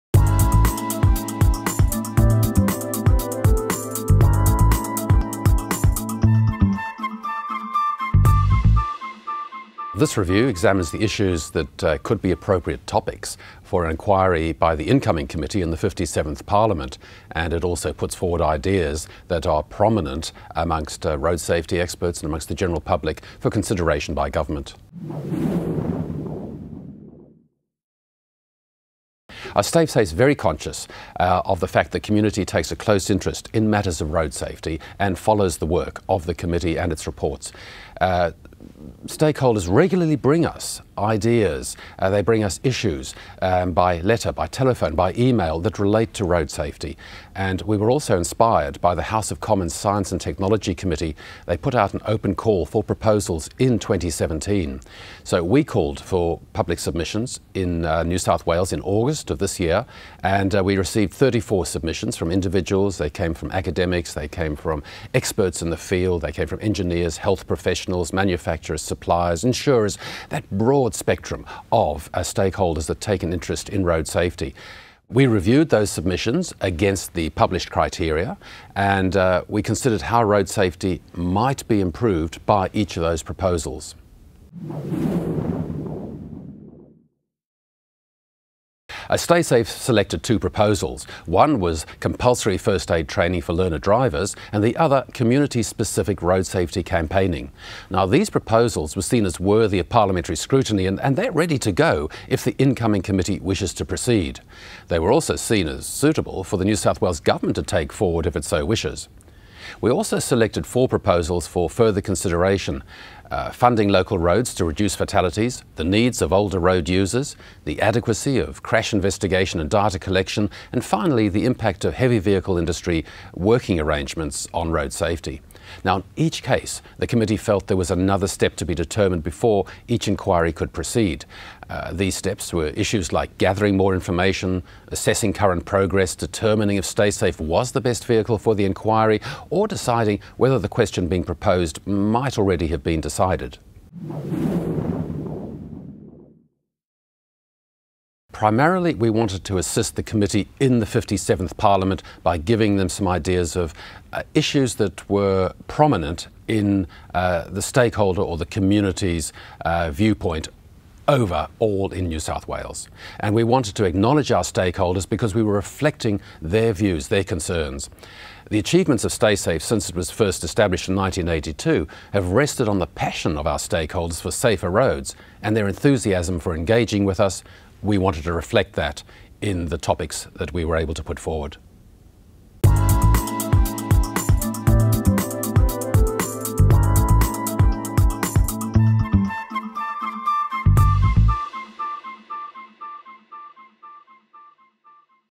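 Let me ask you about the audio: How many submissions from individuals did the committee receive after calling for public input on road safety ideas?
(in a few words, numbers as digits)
34.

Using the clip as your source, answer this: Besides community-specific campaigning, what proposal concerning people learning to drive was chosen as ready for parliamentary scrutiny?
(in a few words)
Compulsory first aid training.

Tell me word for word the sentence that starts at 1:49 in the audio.
We also selected four proposals for further consideration.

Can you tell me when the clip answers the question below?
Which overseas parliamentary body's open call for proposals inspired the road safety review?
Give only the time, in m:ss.
0:49.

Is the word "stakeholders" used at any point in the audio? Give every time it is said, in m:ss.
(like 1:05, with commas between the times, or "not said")
0:39, 1:12, 2:37, 2:44, 2:53.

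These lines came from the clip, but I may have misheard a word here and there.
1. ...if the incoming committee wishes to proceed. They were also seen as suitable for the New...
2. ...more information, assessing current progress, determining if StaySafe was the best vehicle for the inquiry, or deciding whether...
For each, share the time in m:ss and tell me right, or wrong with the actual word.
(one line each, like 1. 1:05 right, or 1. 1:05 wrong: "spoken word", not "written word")
1. 1:42 right
2. 2:13 right.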